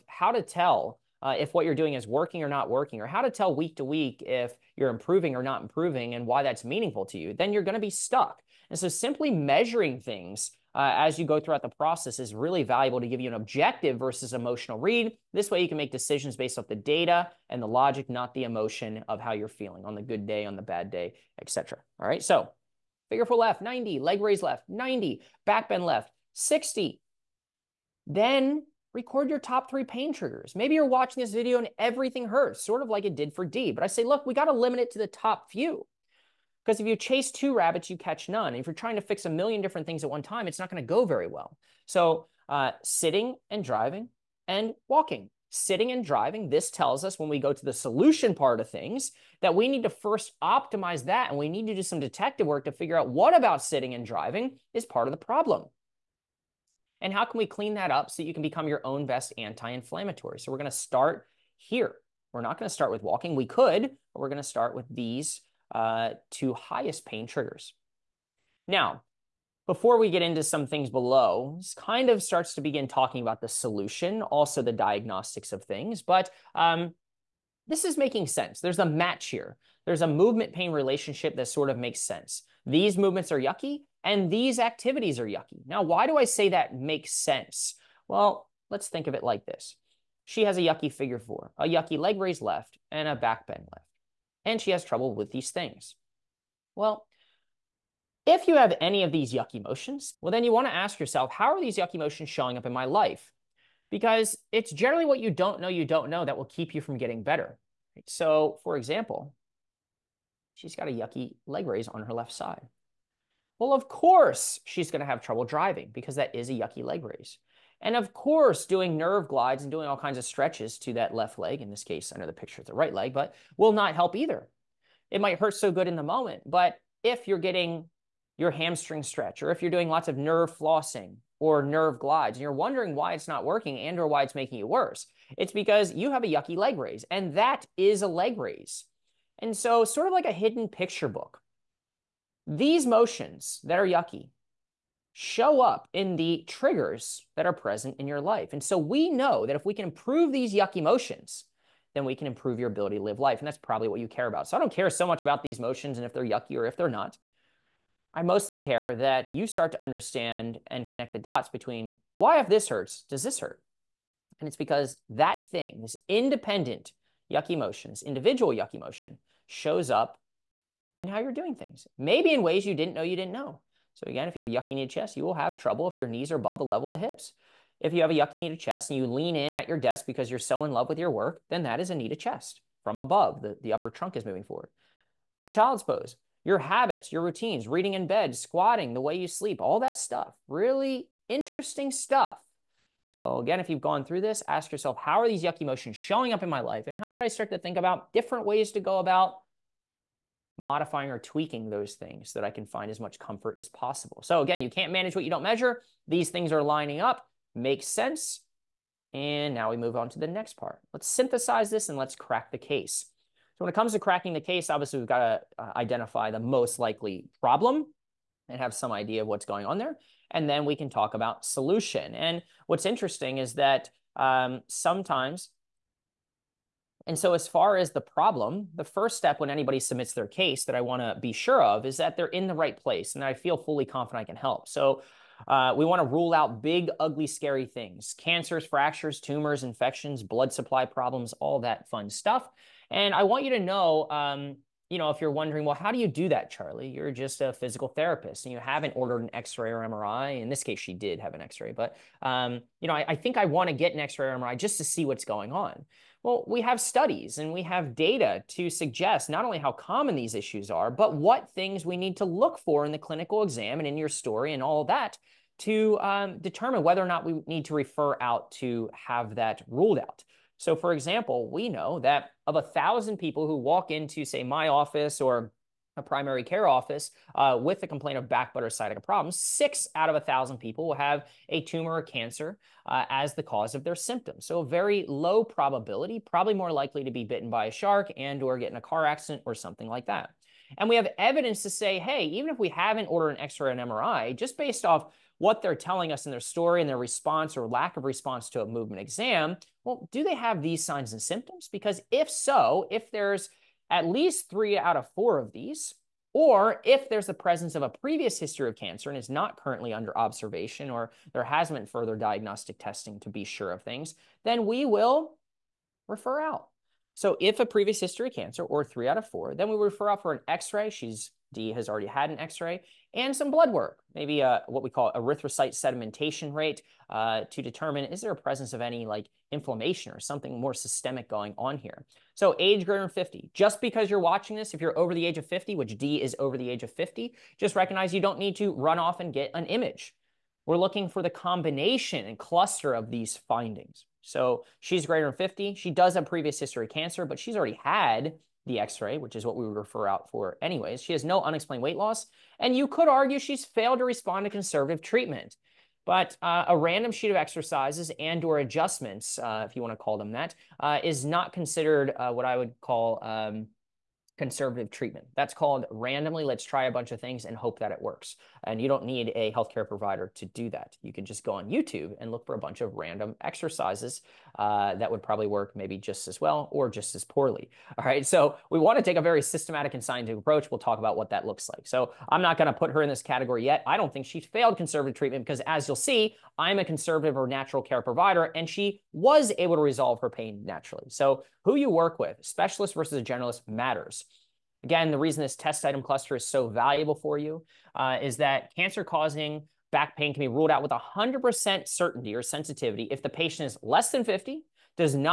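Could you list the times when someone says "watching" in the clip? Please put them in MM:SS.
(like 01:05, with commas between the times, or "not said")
00:30, 05:34.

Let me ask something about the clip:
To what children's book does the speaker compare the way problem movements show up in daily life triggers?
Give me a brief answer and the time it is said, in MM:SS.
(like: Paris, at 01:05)
hidden picture book, at 02:20.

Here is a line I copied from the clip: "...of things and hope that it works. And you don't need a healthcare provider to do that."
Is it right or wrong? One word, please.
right.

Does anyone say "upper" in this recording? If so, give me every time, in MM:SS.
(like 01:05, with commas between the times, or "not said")
03:03.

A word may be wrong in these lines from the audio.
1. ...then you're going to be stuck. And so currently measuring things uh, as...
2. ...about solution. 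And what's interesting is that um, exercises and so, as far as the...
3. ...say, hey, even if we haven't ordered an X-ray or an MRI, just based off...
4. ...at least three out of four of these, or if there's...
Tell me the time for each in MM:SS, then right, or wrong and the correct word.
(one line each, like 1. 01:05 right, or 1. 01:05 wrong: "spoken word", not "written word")
1. 00:07 wrong: "simply", not "currently"
2. 03:41 wrong: "sometimes", not "exercises"
3. 04:51 right
4. 05:03 right.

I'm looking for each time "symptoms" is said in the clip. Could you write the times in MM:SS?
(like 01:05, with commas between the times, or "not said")
04:43, 05:01.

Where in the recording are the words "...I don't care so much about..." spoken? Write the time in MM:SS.
02:34.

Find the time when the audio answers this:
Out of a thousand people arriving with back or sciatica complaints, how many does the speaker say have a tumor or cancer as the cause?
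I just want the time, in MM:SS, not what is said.
04:39.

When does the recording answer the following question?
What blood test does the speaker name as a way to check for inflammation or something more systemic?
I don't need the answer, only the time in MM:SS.
05:25.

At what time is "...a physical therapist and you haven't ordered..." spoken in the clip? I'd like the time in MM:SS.
04:07.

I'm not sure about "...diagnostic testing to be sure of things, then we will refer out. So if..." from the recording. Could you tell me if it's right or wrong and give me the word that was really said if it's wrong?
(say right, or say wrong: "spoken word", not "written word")
right.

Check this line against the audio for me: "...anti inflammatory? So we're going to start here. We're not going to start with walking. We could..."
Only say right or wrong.
right.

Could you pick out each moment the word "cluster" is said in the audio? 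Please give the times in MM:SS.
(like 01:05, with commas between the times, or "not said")
05:42, 06:36.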